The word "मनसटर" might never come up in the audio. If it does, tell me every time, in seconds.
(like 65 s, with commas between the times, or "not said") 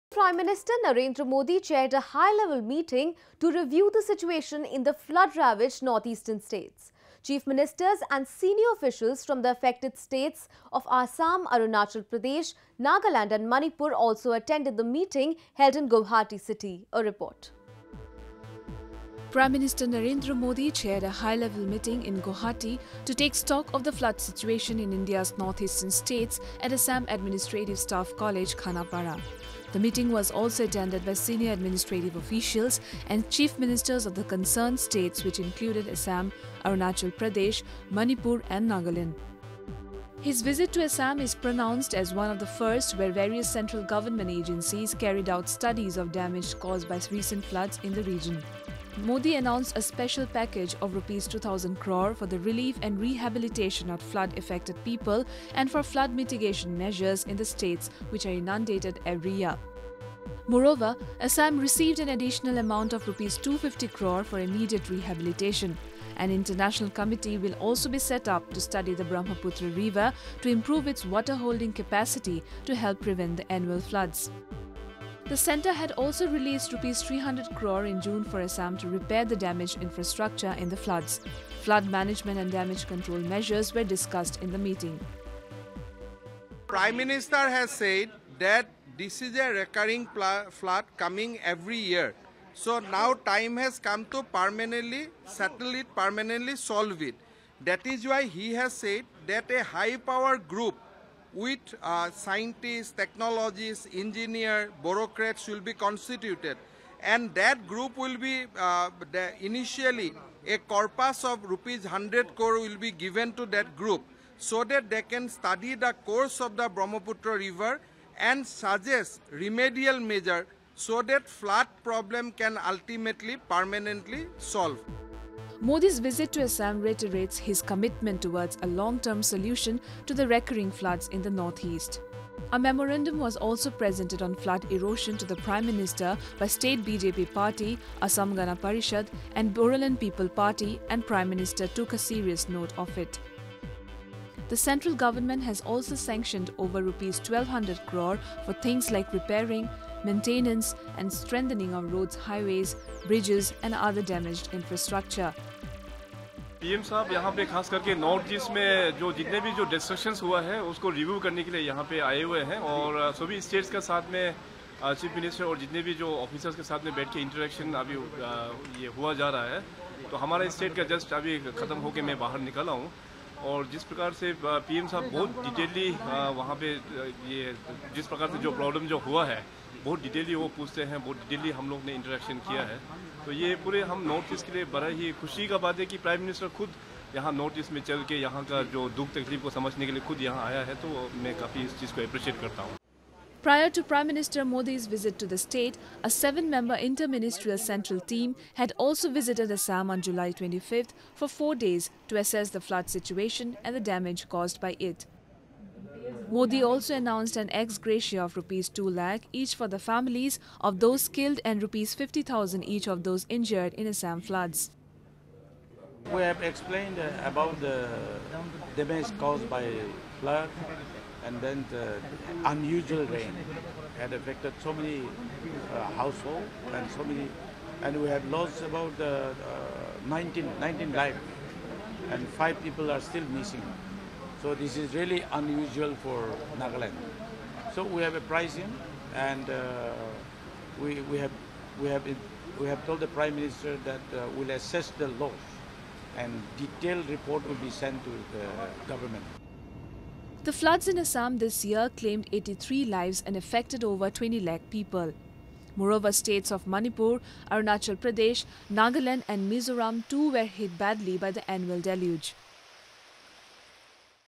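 165 s, 186 s.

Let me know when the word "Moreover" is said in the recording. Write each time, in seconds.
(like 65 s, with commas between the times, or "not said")
60 s, 255 s.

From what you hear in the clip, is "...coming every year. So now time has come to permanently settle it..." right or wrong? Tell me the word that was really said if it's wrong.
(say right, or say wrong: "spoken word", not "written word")
right.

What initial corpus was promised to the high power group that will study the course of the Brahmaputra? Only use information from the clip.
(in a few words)
100 crore rupees.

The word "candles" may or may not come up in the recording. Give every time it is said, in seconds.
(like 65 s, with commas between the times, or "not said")
not said.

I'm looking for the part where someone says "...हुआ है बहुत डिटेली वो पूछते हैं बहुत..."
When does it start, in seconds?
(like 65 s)
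179 s.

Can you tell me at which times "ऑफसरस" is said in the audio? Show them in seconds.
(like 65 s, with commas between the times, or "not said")
166 s.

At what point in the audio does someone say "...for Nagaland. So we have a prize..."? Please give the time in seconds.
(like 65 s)
236 s.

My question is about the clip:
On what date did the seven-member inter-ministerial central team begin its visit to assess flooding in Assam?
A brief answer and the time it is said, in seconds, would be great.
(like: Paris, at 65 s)
July 25, at 200 s.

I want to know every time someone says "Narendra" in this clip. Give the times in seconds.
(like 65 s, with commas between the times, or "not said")
0 s, 19 s.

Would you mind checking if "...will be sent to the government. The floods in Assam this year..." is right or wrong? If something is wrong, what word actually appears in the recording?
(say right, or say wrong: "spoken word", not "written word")
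right.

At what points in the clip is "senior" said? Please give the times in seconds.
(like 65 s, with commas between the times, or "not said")
8 s, 31 s.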